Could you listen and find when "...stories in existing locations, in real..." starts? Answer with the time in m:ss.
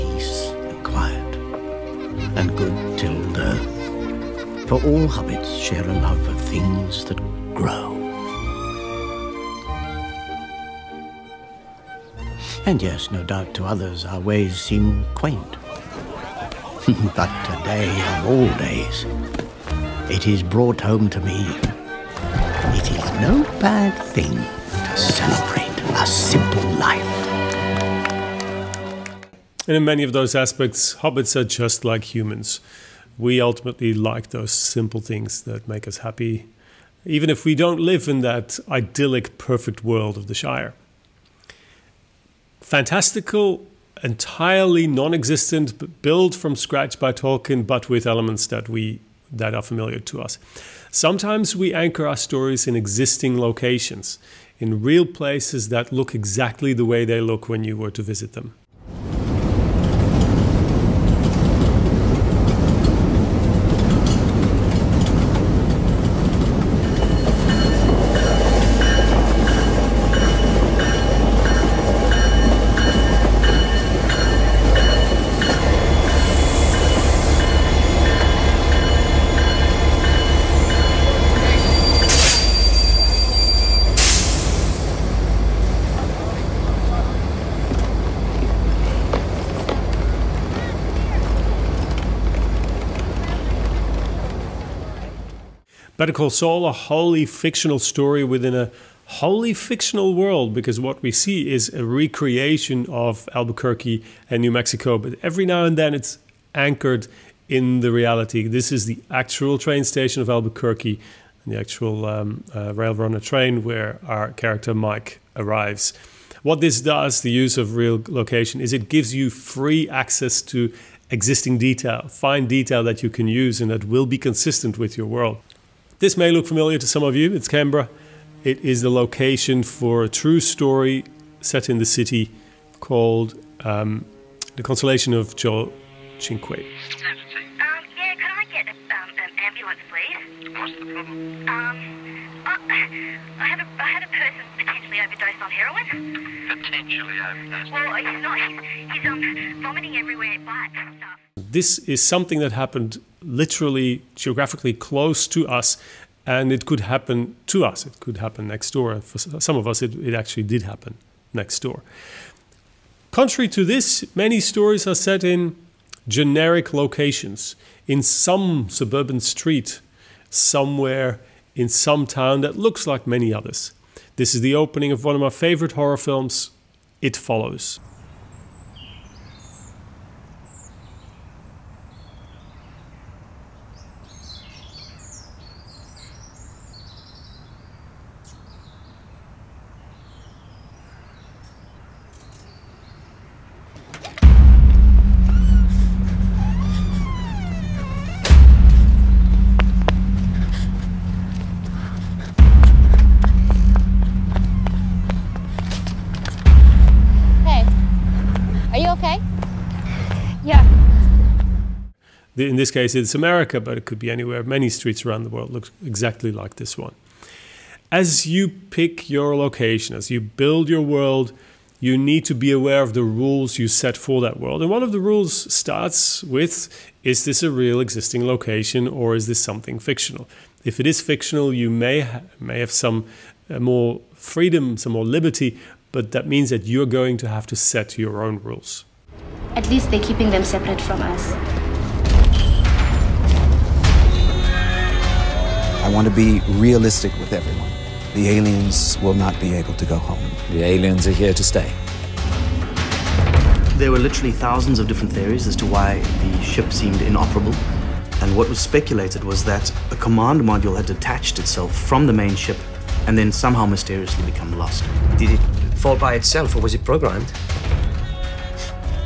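0:52.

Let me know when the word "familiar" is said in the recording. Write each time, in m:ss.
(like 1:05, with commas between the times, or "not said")
0:49, 2:06.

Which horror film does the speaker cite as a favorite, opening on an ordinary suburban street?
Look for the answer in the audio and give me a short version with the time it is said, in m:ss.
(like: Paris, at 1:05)
It Follows, at 2:57.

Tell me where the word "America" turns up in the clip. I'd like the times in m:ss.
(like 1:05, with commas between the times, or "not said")
3:33.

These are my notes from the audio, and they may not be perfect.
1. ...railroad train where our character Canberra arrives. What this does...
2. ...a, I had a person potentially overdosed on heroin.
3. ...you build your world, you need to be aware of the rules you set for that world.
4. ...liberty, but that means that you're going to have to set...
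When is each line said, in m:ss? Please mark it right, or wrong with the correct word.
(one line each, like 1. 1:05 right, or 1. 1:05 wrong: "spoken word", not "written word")
1. 1:52 wrong: "Mike", not "Canberra"
2. 2:23 right
3. 3:40 right
4. 3:55 right.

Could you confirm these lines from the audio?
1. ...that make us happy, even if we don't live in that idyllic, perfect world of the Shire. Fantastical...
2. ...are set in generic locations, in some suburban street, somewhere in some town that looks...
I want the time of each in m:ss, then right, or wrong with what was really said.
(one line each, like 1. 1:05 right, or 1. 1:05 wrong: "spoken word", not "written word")
1. 0:35 right
2. 2:44 right.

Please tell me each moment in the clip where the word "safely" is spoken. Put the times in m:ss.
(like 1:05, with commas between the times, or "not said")
not said.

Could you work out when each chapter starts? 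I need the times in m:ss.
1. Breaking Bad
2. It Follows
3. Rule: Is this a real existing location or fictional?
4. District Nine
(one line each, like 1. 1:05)
1. 0:49
2. 2:42
3. 3:37
4. 3:58.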